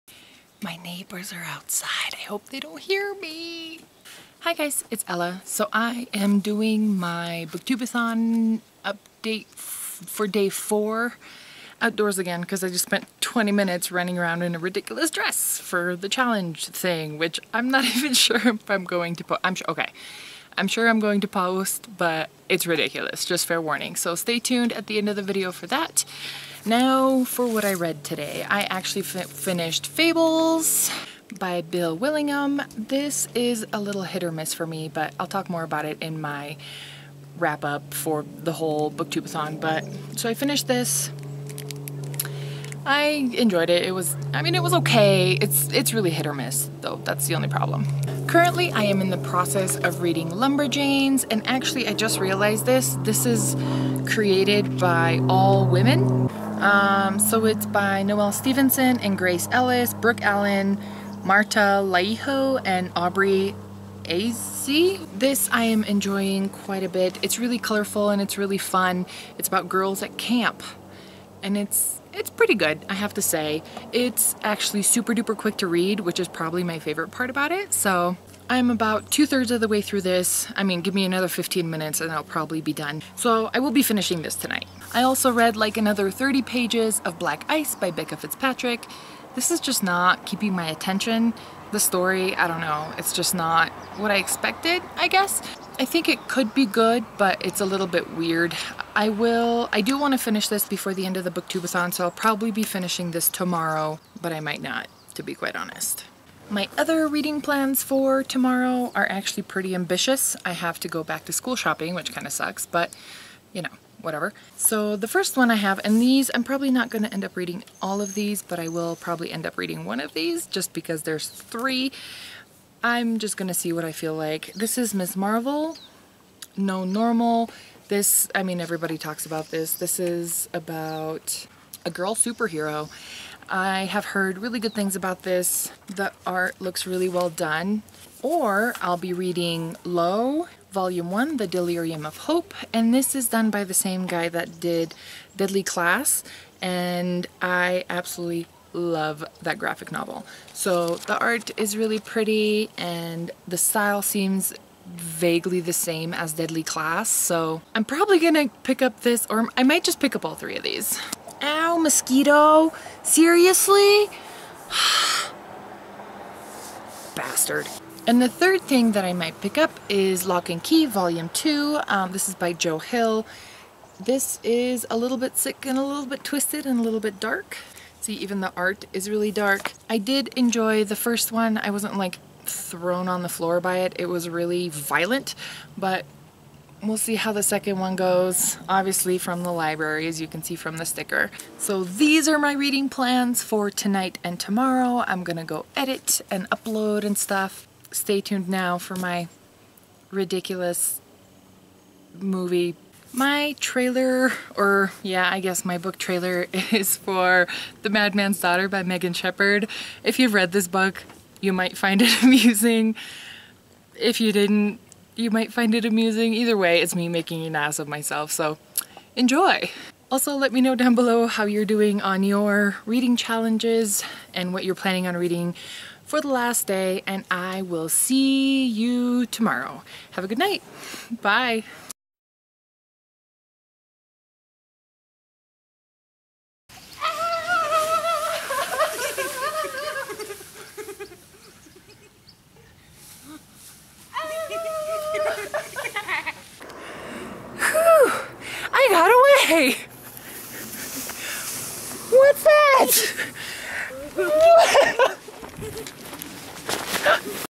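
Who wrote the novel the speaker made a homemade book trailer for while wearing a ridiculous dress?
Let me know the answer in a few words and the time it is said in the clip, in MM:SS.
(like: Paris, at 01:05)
Megan Shepherd, at 03:28.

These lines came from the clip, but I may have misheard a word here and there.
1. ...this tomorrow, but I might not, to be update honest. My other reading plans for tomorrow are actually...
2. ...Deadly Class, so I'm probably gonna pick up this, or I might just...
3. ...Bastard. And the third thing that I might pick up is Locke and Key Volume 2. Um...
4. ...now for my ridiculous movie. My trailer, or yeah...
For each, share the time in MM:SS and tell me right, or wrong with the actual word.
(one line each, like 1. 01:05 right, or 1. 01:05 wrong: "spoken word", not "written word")
1. 01:43 wrong: "quite", not "update"
2. 02:36 right
3. 02:47 right
4. 03:18 right.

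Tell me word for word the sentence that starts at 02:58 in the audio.
See, even the art is really dark.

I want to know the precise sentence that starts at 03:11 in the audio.
So these are my reading plans for tonight and tomorrow.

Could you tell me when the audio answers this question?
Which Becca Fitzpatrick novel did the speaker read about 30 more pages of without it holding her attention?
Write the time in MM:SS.
01:27.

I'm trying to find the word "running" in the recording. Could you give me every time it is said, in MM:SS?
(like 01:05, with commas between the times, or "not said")
00:13.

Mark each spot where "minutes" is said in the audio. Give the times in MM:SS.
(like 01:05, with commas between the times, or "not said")
00:13, 01:21.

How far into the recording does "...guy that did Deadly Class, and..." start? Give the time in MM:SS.
02:24.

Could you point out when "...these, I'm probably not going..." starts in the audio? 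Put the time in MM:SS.
01:56.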